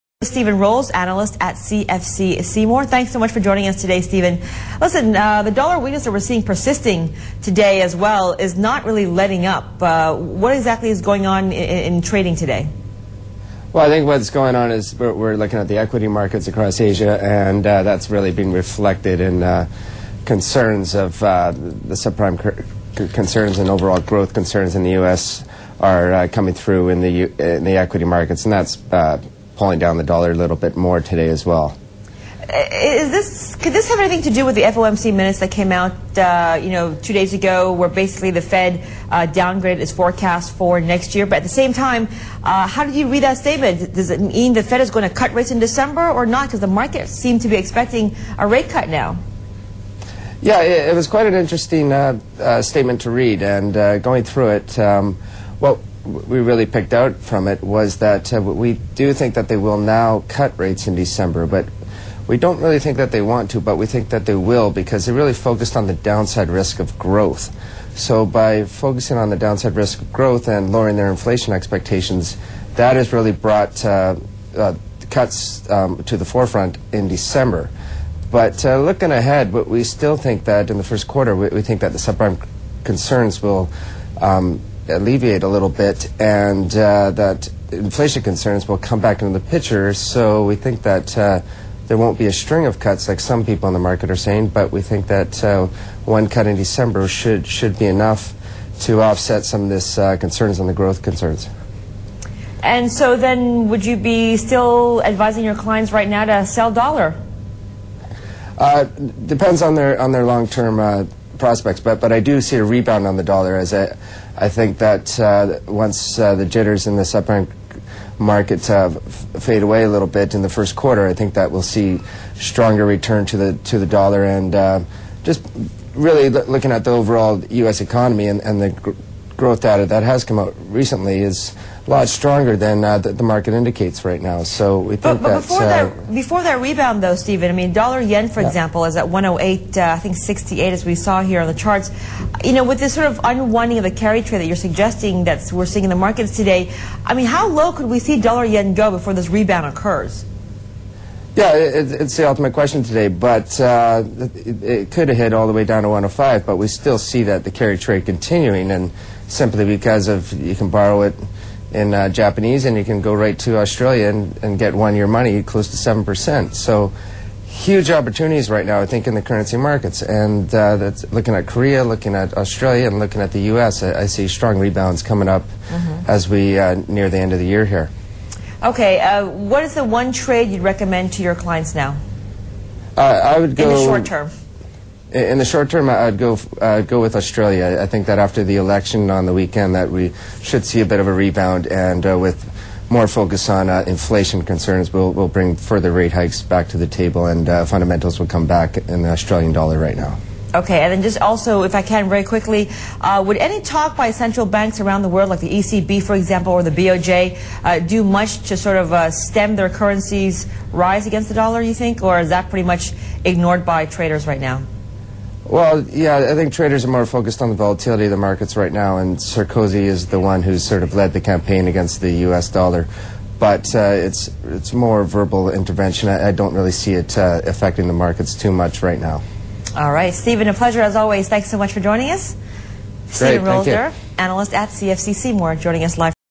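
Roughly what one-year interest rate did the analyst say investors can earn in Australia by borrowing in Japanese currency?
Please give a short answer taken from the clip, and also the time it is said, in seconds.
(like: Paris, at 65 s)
7%, at 165 s.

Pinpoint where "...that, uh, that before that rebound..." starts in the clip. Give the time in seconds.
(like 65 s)
135 s.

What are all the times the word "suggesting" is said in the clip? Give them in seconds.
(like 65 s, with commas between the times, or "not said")
144 s.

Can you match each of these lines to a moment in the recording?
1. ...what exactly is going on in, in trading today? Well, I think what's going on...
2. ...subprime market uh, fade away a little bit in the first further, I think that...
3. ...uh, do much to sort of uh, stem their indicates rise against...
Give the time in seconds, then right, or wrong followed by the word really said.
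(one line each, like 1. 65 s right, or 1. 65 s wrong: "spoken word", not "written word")
1. 10 s right
2. 117 s wrong: "quarter", not "further"
3. 207 s wrong: "currencies", not "indicates".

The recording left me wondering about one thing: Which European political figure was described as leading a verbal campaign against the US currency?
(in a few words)
Sarkozy.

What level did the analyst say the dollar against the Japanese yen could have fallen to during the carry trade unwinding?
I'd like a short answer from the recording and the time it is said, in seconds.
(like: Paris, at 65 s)
105, at 155 s.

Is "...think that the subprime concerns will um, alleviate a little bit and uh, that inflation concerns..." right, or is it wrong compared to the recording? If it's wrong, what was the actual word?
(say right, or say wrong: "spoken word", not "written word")
right.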